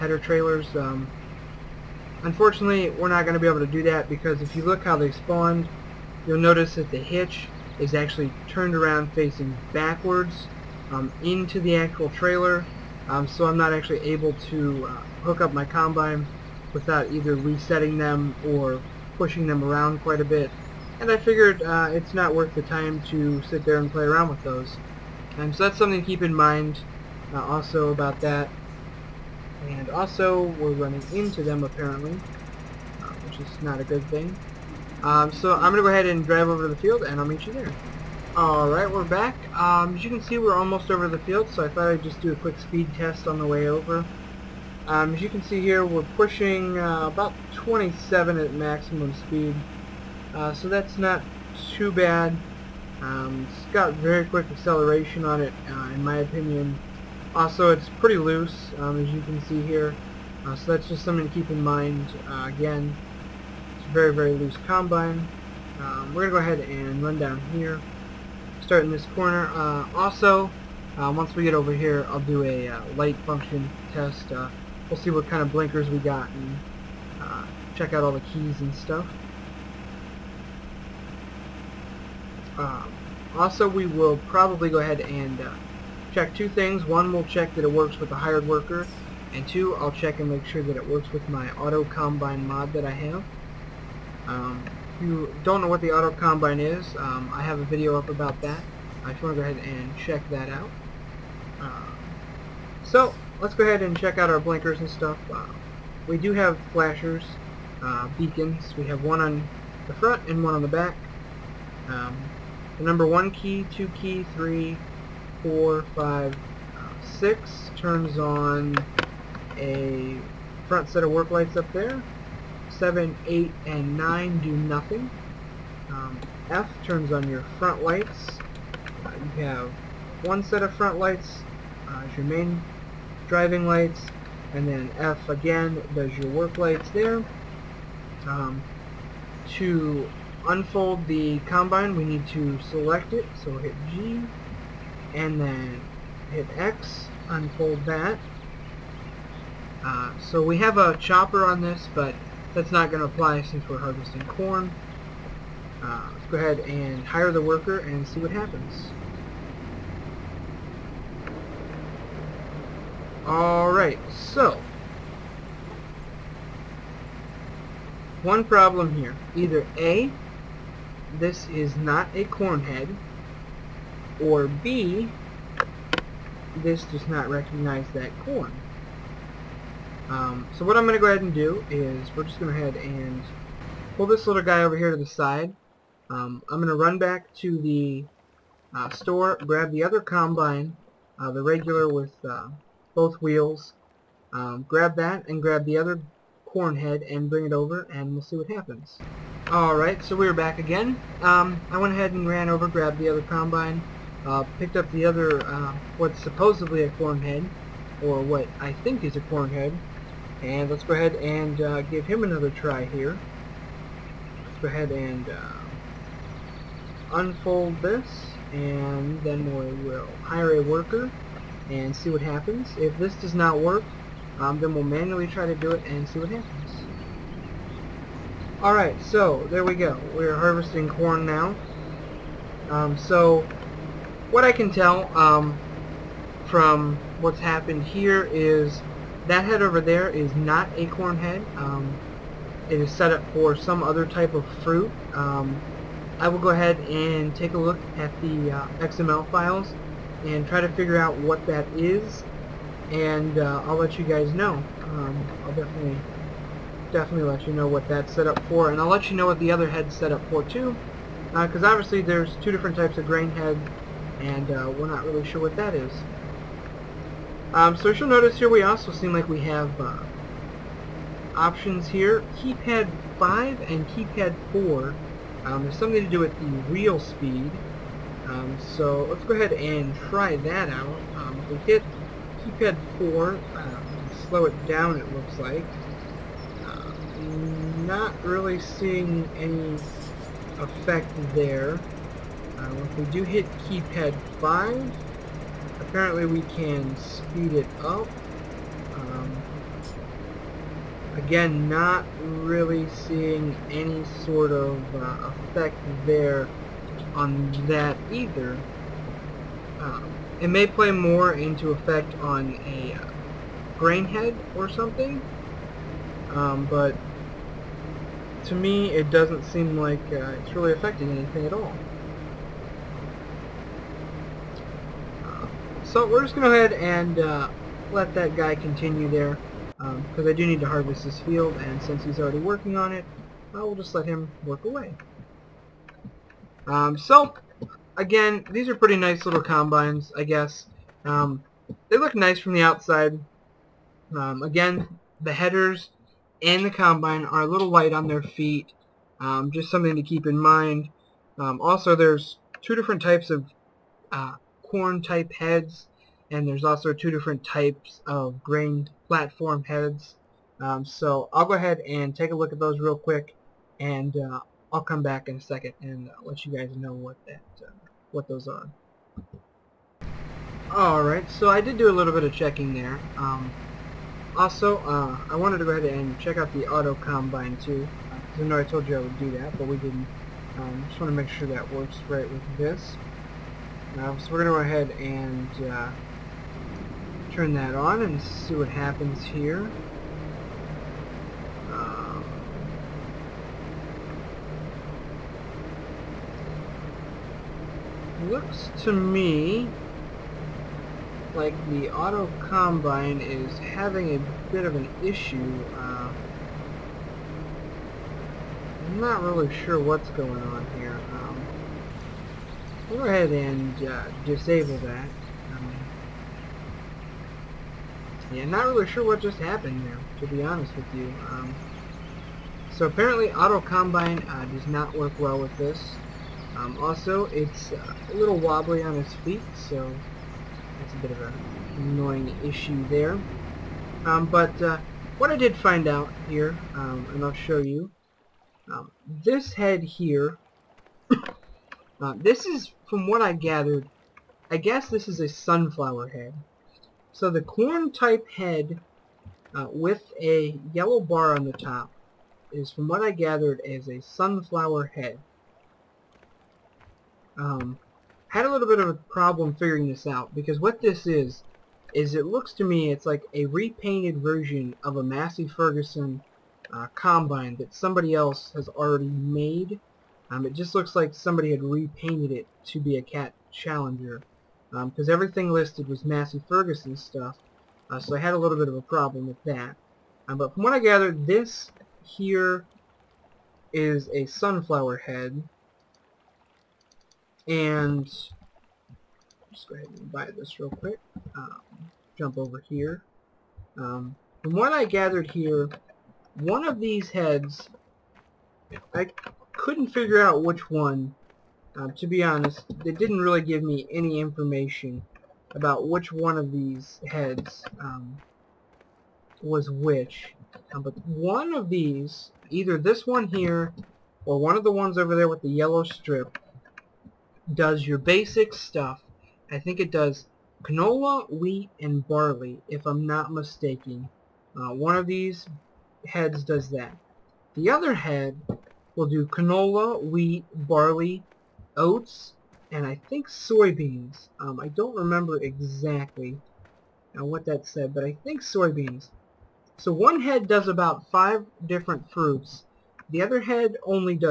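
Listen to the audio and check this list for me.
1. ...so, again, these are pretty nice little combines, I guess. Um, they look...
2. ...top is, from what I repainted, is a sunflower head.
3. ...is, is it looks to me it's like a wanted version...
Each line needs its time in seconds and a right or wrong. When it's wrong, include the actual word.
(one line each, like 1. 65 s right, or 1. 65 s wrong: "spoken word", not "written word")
1. 336 s right
2. 451 s wrong: "gathered", not "repainted"
3. 461 s wrong: "repainted", not "wanted".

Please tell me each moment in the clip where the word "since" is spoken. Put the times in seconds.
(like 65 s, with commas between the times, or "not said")
153 s, 331 s.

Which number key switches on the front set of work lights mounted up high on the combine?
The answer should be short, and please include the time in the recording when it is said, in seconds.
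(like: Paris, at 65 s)
6, at 117 s.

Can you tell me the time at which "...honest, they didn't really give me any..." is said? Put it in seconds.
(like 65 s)
502 s.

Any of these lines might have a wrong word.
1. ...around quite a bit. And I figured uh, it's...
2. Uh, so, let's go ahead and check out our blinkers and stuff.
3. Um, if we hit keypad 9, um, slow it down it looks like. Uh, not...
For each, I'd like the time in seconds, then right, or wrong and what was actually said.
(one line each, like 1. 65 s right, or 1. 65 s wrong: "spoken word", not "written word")
1. 19 s right
2. 101 s right
3. 281 s wrong: "4", not "9".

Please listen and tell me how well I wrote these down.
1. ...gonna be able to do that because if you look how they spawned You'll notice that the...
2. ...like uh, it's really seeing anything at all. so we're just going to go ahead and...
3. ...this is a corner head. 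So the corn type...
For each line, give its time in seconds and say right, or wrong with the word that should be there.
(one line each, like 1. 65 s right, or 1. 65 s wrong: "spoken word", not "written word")
1. 3 s right
2. 319 s wrong: "affecting", not "seeing"
3. 444 s wrong: "sunflower", not "corner".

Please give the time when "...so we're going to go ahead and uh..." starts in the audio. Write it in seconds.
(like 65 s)
384 s.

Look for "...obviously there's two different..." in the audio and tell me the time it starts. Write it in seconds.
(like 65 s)
261 s.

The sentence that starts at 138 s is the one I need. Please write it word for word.
Um, to unfold the combine, we need to select it, so hit G, and then hit X, unfold that.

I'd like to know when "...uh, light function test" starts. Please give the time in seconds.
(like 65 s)
72 s.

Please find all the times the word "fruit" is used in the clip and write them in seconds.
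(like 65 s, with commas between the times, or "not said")
244 s, 542 s.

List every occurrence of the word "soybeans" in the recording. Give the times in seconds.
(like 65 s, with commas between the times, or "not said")
533 s, 538 s.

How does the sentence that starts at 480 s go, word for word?
Um, but from what I gathered, this here is a sunflower head, and just go ahead and buy this real quick.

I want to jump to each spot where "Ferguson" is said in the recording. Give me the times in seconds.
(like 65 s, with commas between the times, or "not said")
465 s, 476 s.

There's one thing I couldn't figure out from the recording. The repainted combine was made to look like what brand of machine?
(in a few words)
Cat Challenger.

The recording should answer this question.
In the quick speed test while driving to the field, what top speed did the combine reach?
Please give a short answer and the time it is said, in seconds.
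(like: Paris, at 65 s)
27, at 47 s.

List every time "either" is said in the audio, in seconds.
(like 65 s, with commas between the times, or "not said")
17 s, 169 s, 308 s, 512 s.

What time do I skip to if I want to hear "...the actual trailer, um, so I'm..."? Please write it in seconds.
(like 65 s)
11 s.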